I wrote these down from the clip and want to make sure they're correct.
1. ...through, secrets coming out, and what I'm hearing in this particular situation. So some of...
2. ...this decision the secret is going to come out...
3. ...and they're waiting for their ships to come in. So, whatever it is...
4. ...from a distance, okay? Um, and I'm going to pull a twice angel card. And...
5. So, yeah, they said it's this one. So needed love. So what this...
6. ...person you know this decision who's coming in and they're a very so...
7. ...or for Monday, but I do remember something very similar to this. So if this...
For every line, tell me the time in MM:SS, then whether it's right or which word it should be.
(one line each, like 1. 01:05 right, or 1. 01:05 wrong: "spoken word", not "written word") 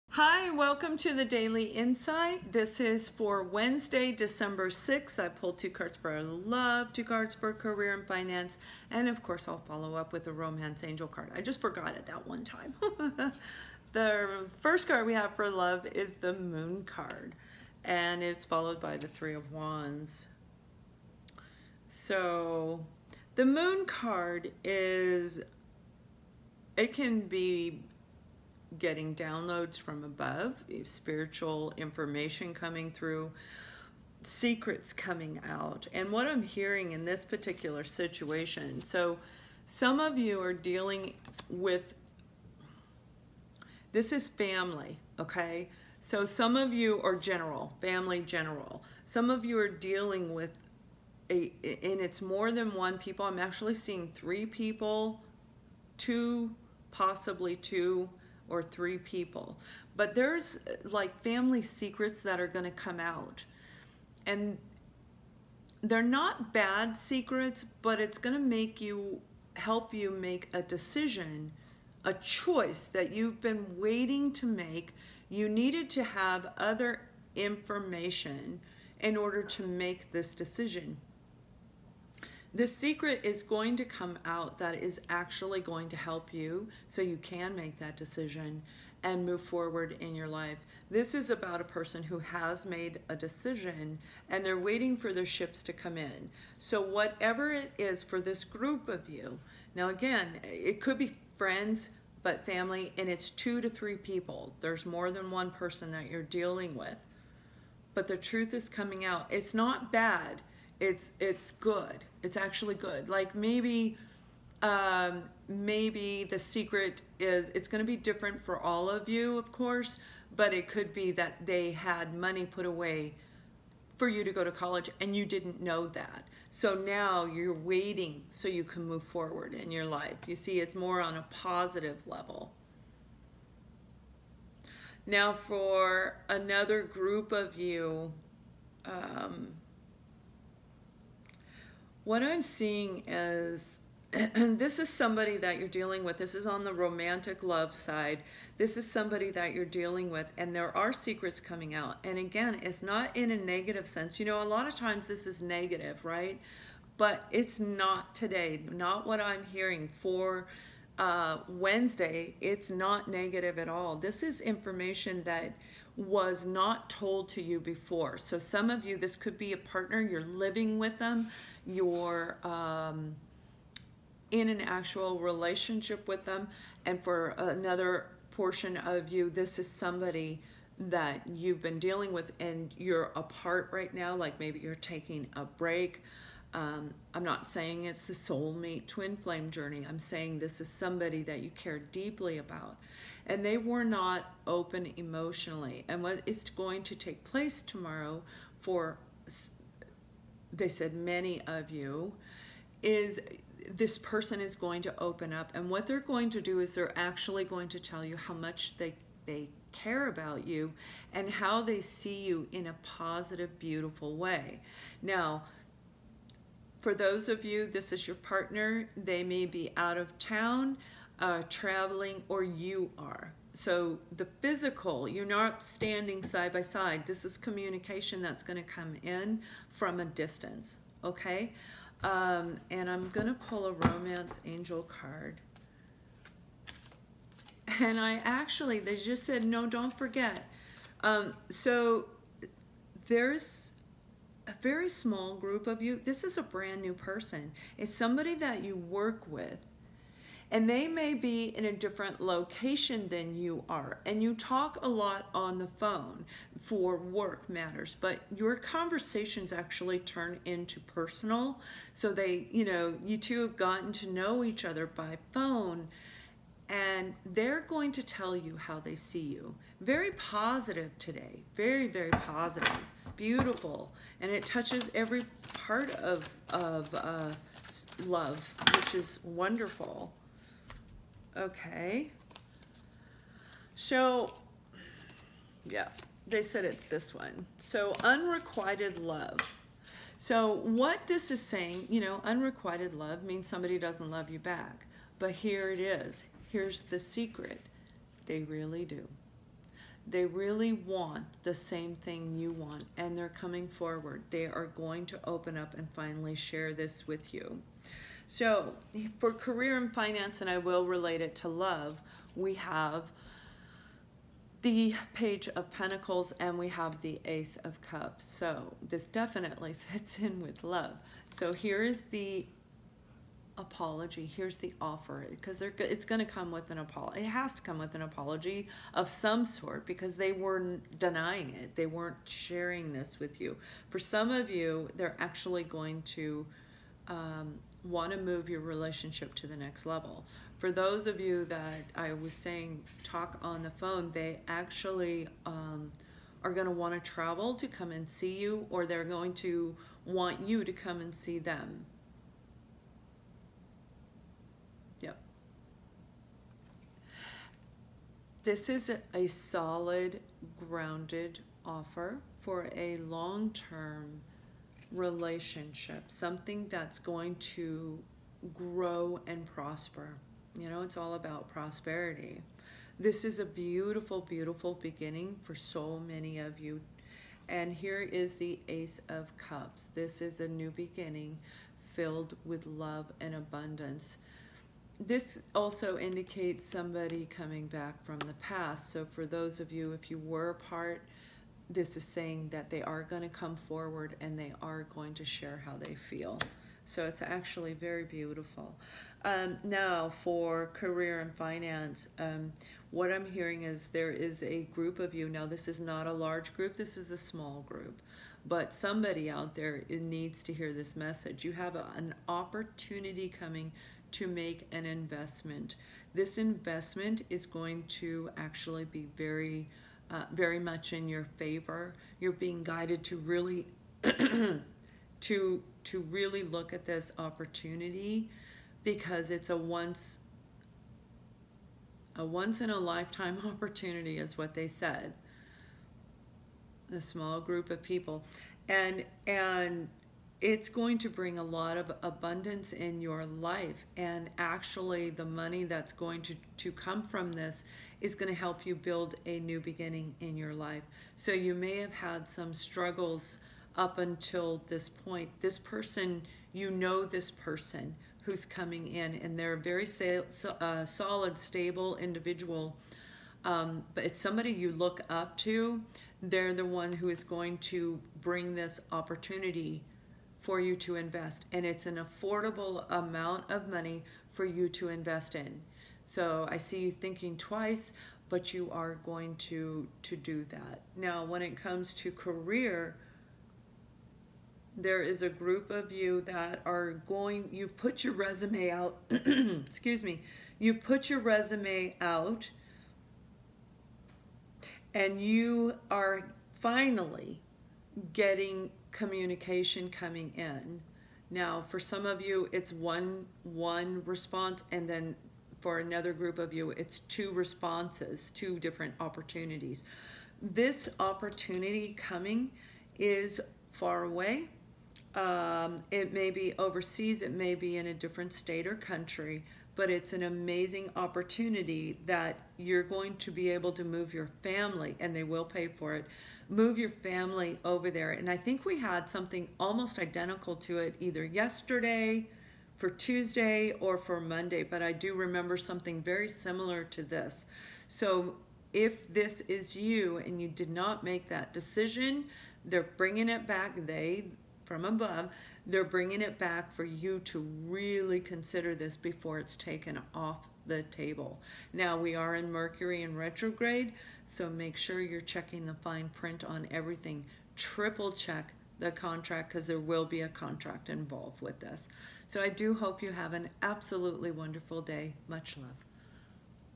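1. 00:32 right
2. 01:20 right
3. 01:34 right
4. 03:49 wrong: "romance", not "twice"
5. 04:43 wrong: "unrequited", not "needed"
6. 07:35 wrong: "person", not "decision"
7. 08:53 right.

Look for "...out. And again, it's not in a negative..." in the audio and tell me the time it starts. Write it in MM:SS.
02:31.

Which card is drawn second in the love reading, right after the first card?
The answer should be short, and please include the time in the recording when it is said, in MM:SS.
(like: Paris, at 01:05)
Three of Wands, at 00:19.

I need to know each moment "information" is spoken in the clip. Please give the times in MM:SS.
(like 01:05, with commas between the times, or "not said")
00:31, 01:17, 02:44.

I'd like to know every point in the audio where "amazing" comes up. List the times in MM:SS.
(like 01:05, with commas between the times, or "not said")
08:40.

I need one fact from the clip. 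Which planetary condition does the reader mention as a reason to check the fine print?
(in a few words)
Mercury in retrograde.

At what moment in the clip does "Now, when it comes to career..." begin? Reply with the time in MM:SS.
08:00.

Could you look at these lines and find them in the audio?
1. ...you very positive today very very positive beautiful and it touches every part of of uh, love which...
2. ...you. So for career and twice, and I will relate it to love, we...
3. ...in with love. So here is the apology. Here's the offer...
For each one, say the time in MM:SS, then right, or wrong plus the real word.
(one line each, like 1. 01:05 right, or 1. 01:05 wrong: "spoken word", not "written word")
1. 04:29 right
2. 05:07 wrong: "finance", not "twice"
3. 05:20 right.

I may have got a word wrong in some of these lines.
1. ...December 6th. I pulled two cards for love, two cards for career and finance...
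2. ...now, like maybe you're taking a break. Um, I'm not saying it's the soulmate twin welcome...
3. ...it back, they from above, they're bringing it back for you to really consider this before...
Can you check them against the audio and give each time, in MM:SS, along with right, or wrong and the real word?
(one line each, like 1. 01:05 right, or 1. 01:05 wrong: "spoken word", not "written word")
1. 00:04 right
2. 03:03 wrong: "flame", not "welcome"
3. 09:03 right.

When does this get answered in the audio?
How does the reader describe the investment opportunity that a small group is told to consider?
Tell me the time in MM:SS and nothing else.
07:12.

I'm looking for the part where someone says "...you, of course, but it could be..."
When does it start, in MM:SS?
01:59.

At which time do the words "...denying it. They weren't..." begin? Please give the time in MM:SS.
05:30.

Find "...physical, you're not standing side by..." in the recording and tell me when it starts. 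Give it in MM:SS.
03:44.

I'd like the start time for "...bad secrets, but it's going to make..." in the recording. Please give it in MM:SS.
01:06.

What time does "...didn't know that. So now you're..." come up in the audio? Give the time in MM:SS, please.
02:05.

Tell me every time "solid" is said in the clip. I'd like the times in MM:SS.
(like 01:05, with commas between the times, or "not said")
05:59, 07:40.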